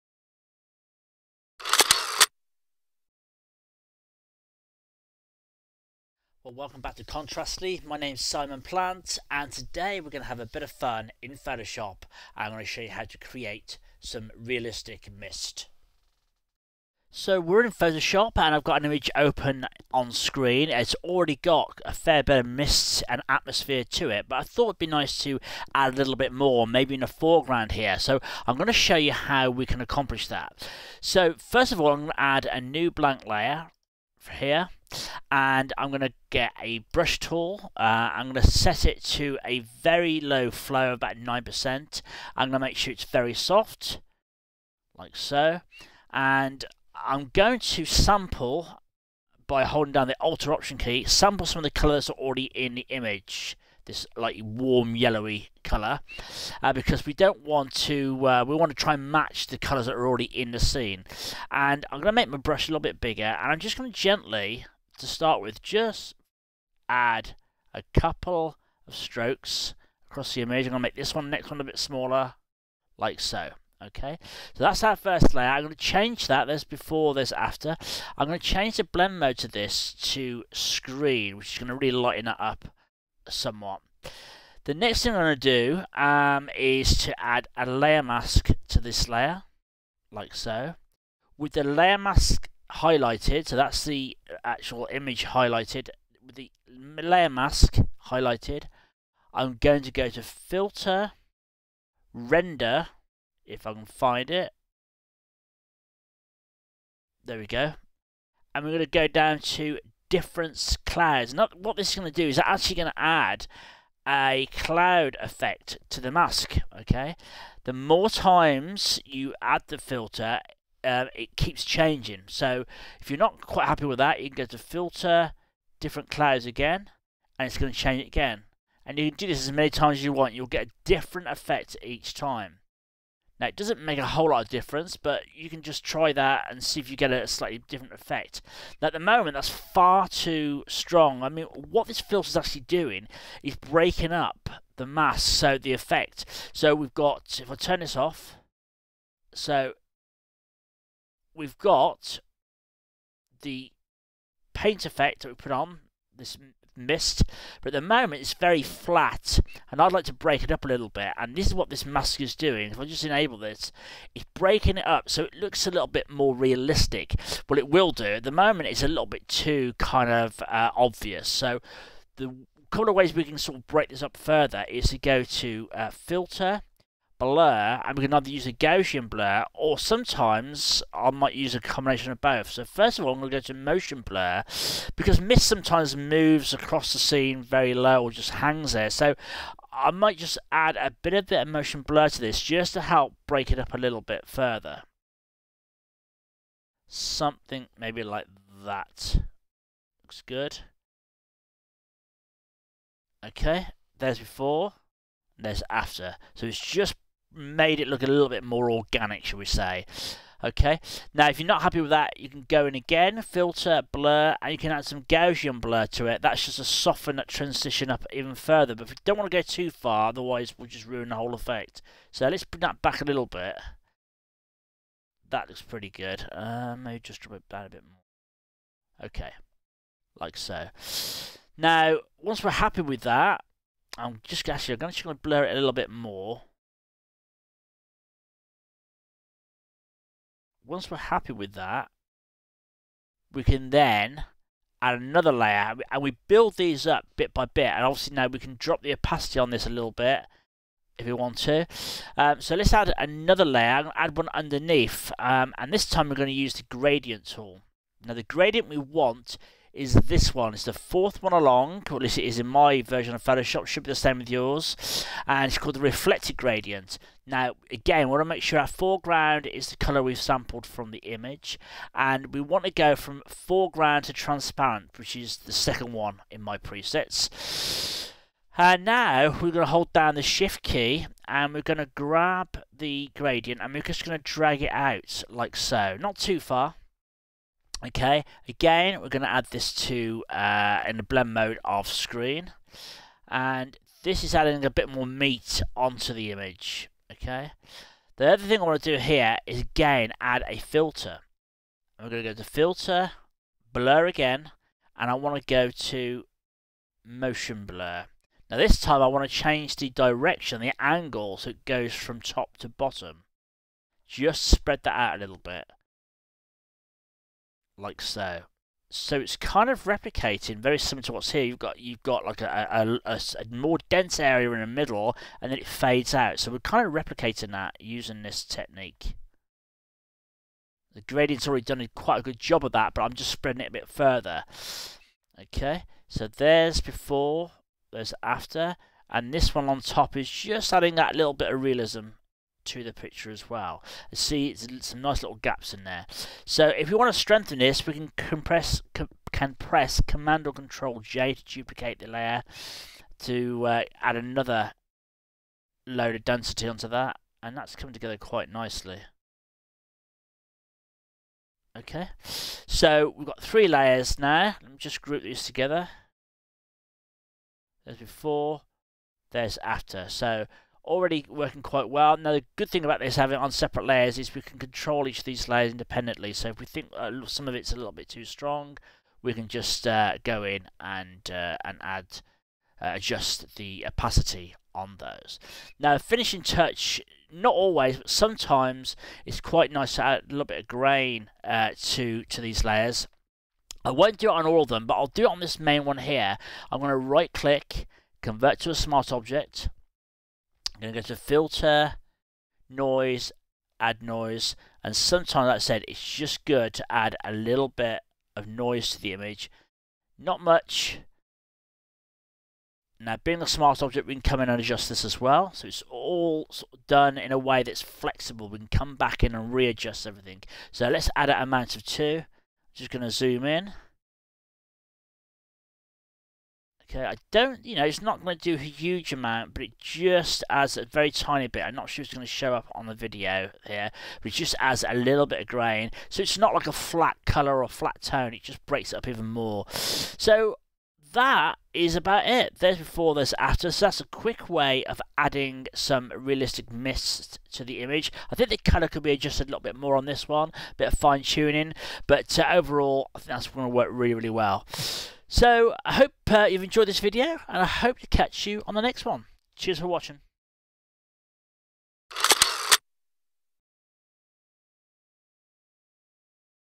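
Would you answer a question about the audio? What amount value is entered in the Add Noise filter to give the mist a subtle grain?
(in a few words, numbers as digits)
2.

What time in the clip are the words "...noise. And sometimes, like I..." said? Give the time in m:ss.
6:44.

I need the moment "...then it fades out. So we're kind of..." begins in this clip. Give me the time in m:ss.
5:25.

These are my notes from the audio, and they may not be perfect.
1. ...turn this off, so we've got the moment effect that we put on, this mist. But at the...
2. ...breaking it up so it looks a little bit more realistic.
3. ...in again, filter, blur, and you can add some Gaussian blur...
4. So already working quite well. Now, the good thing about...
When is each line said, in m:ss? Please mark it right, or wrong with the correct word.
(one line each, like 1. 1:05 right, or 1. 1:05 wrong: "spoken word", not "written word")
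1. 2:27 wrong: "paint", not "moment"
2. 2:44 right
3. 3:32 right
4. 6:10 right.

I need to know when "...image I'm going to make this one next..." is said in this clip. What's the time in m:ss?
1:10.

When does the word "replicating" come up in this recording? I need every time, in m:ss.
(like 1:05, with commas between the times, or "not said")
5:19, 5:26.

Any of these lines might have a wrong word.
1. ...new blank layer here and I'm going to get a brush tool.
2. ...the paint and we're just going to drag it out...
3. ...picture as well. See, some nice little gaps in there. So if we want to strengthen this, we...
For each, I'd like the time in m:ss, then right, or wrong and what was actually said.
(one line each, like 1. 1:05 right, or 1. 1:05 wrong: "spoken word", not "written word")
1. 0:32 right
2. 4:42 wrong: "gradient", not "paint"
3. 5:42 right.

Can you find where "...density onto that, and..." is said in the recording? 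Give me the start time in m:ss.
5:56.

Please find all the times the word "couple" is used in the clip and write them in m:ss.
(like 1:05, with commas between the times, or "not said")
1:07, 2:52.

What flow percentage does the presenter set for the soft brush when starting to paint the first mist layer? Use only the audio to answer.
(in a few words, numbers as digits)
9%.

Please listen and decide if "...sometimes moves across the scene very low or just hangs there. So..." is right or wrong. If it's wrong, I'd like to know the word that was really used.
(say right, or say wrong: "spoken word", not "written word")
right.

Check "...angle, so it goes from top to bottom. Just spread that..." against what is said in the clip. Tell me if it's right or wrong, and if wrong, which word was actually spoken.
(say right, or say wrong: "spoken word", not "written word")
right.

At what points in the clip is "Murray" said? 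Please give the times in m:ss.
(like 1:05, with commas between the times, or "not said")
not said.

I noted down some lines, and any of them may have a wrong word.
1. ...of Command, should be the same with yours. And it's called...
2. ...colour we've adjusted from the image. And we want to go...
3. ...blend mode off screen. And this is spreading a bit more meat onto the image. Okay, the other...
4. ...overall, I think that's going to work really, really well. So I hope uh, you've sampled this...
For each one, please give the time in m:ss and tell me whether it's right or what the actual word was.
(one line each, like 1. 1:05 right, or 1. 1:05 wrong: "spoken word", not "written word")
1. 4:23 wrong: "Photoshop", not "Command"
2. 4:29 wrong: "sampled", not "adjusted"
3. 4:51 wrong: "adding", not "spreading"
4. 7:32 wrong: "enjoyed", not "sampled".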